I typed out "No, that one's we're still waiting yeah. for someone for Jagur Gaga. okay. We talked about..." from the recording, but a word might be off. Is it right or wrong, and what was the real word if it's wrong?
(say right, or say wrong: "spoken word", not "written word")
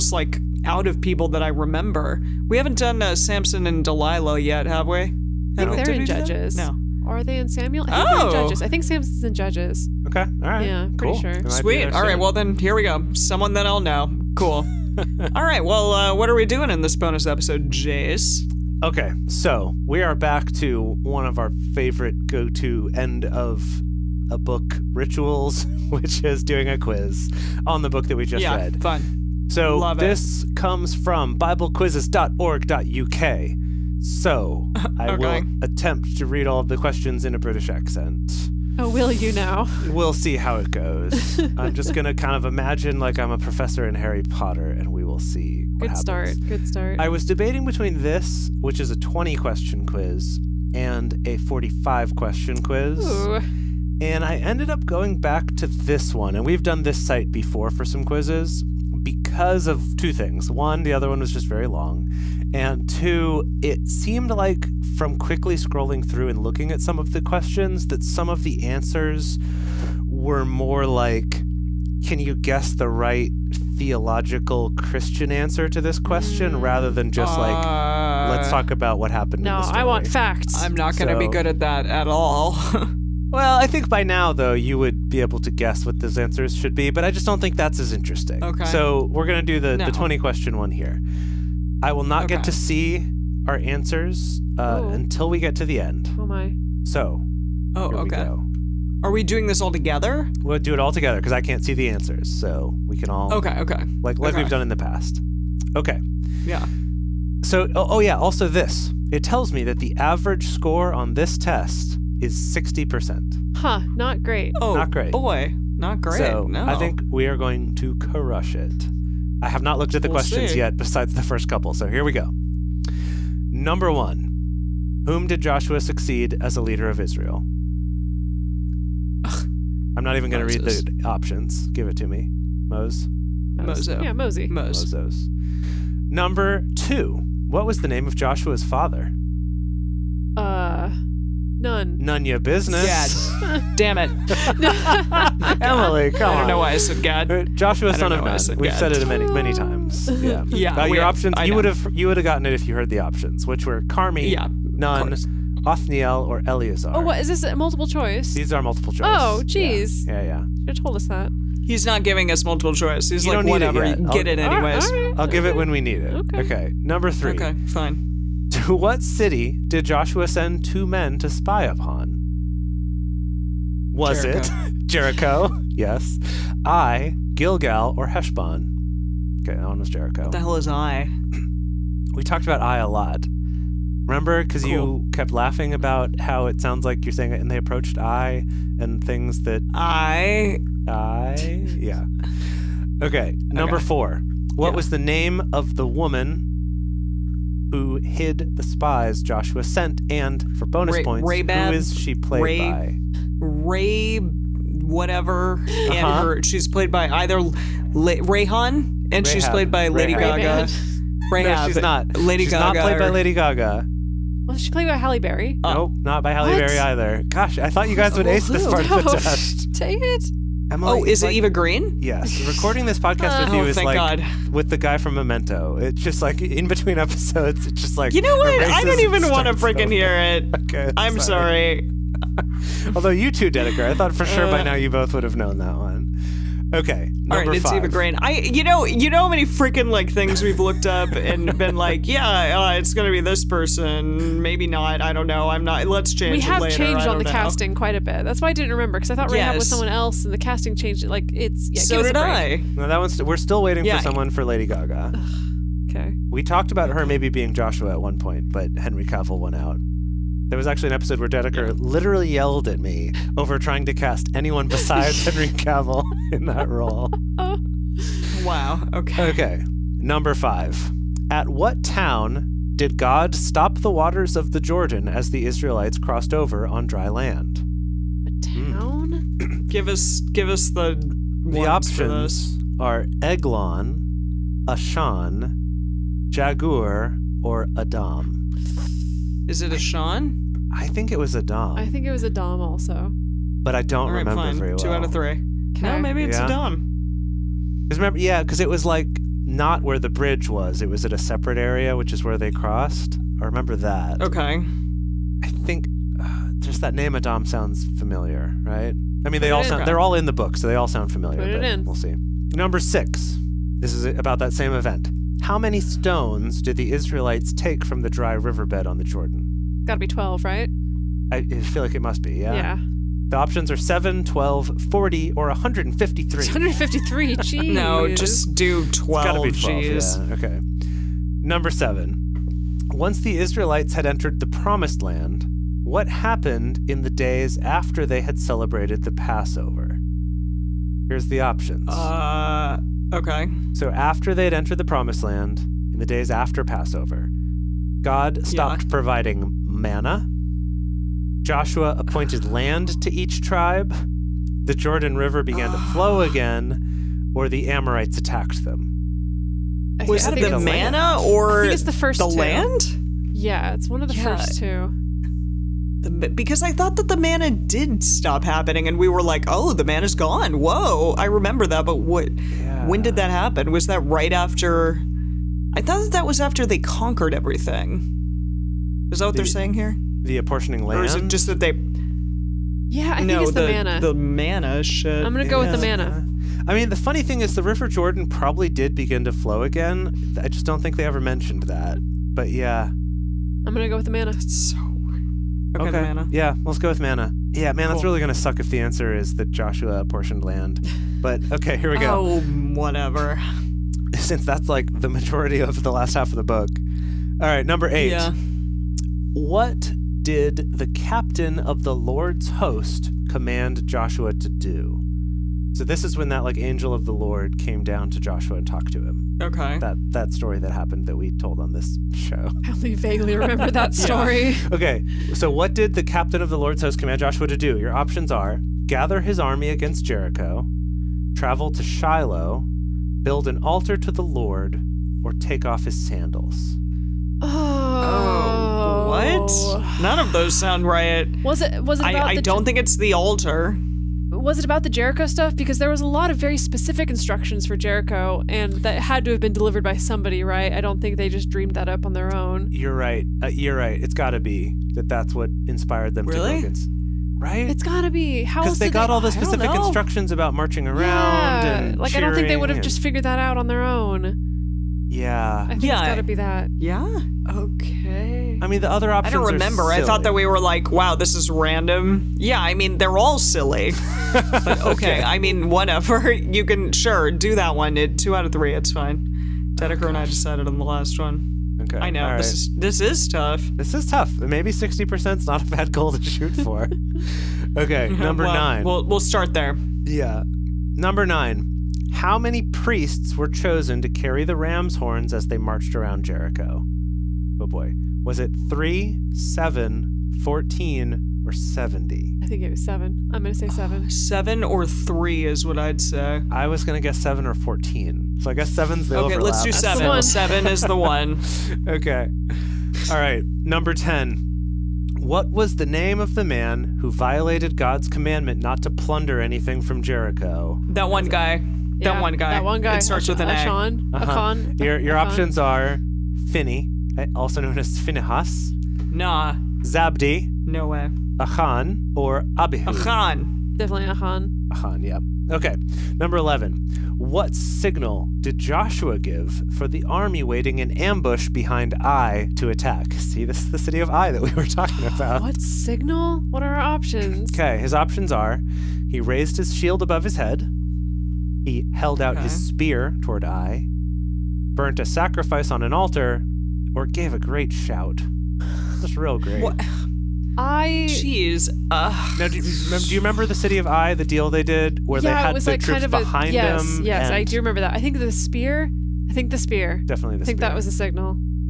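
wrong: "Lady", not "Jagur".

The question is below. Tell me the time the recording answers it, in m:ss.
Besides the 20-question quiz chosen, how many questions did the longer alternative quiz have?
0:51.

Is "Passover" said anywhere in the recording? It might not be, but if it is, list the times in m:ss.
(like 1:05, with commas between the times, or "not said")
5:39, 5:46.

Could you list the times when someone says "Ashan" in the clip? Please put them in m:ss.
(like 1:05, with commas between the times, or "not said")
4:44, 4:49, 8:43.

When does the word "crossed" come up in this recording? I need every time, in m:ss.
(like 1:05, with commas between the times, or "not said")
4:35, 5:02.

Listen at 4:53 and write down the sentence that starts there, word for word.
But I don't right, remember fine.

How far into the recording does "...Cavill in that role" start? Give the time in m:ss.
4:25.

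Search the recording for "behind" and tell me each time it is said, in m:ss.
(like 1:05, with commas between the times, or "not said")
9:01, 9:26.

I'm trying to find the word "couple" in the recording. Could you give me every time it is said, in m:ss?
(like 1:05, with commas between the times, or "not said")
2:01.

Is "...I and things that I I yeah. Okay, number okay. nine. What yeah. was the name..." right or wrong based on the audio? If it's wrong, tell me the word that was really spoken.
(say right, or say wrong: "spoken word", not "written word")
wrong: "four", not "nine".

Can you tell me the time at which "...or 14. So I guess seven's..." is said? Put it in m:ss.
8:27.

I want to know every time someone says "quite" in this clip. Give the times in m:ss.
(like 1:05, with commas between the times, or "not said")
4:07.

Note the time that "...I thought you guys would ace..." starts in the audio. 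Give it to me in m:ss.
3:37.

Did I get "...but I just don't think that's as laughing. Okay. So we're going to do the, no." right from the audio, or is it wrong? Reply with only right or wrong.
wrong.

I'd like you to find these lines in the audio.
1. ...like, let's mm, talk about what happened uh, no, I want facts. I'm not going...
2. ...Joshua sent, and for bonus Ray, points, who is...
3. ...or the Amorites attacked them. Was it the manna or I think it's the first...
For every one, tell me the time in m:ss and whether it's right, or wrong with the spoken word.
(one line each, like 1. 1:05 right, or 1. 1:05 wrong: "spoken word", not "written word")
1. 1:17 right
2. 3:19 right
3. 5:57 right.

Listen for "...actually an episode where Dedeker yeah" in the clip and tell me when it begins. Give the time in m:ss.
4:20.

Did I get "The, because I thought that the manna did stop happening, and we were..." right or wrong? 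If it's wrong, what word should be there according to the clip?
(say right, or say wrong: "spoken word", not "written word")
right.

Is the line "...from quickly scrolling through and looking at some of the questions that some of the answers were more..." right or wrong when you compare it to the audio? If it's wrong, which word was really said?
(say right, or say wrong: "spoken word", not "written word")
right.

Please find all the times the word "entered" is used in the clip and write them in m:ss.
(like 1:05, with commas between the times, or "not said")
5:34, 5:44.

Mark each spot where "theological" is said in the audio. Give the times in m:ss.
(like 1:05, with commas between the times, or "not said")
1:13.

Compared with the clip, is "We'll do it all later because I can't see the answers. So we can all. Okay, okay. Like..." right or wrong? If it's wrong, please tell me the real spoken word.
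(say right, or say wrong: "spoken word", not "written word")
wrong: "together", not "later".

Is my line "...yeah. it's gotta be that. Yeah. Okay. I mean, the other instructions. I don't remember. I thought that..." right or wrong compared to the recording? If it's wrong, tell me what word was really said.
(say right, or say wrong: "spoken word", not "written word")
wrong: "options", not "instructions".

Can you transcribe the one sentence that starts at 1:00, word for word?
One, the other one was just very long.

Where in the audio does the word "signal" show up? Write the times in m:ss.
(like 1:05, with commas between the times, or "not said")
8:57, 9:05, 9:30.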